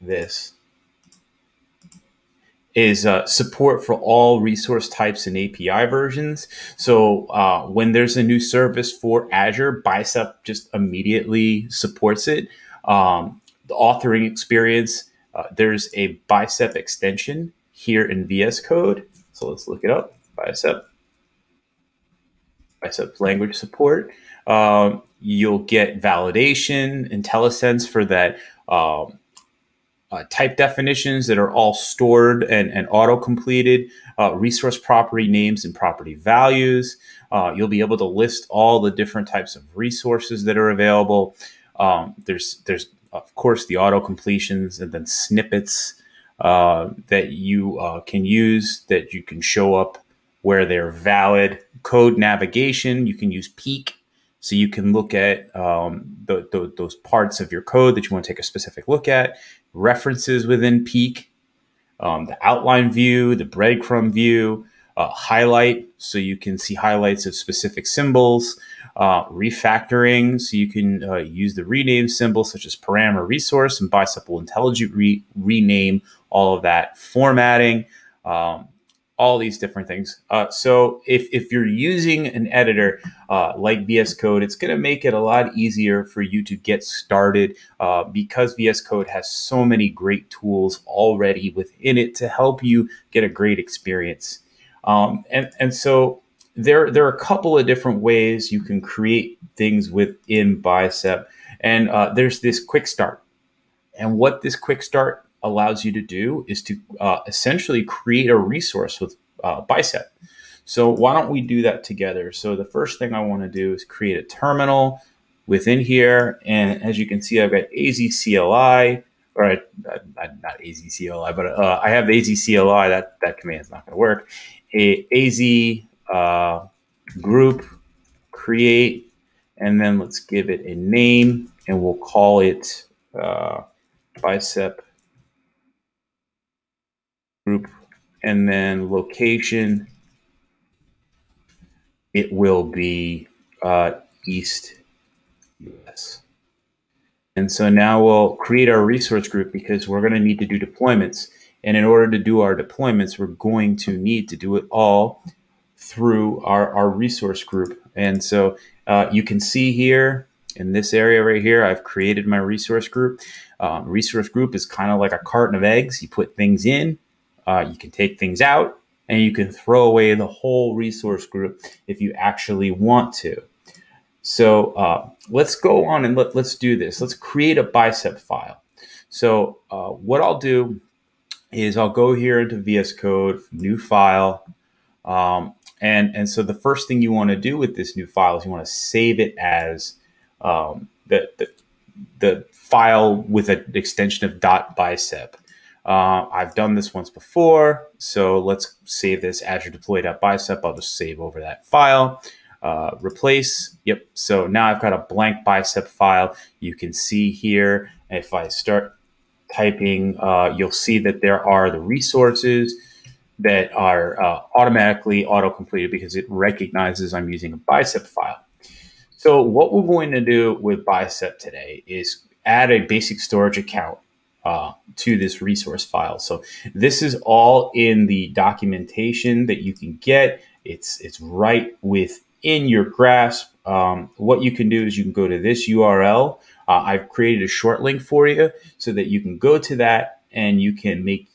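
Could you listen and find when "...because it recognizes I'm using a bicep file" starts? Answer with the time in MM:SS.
03:35.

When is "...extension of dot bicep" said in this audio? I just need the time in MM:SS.
03:13.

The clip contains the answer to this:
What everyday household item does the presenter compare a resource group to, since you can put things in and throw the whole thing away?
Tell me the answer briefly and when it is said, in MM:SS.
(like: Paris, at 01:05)
A carton of eggs, at 02:45.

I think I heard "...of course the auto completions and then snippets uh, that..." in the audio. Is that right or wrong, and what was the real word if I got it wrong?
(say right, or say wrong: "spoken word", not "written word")
right.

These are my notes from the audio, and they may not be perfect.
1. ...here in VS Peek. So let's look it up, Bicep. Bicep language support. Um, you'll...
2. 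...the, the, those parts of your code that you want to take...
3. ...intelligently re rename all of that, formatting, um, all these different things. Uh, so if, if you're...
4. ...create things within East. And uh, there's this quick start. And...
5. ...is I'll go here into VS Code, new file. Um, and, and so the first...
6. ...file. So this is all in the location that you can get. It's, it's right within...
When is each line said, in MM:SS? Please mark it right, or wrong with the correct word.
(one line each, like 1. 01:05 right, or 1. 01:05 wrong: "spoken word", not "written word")
1. 00:17 wrong: "Code", not "Peek"
2. 00:56 right
3. 01:14 right
4. 01:38 wrong: "Bicep", not "East"
5. 03:01 right
6. 03:45 wrong: "documentation", not "location".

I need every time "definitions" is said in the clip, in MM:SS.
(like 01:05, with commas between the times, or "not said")
00:30.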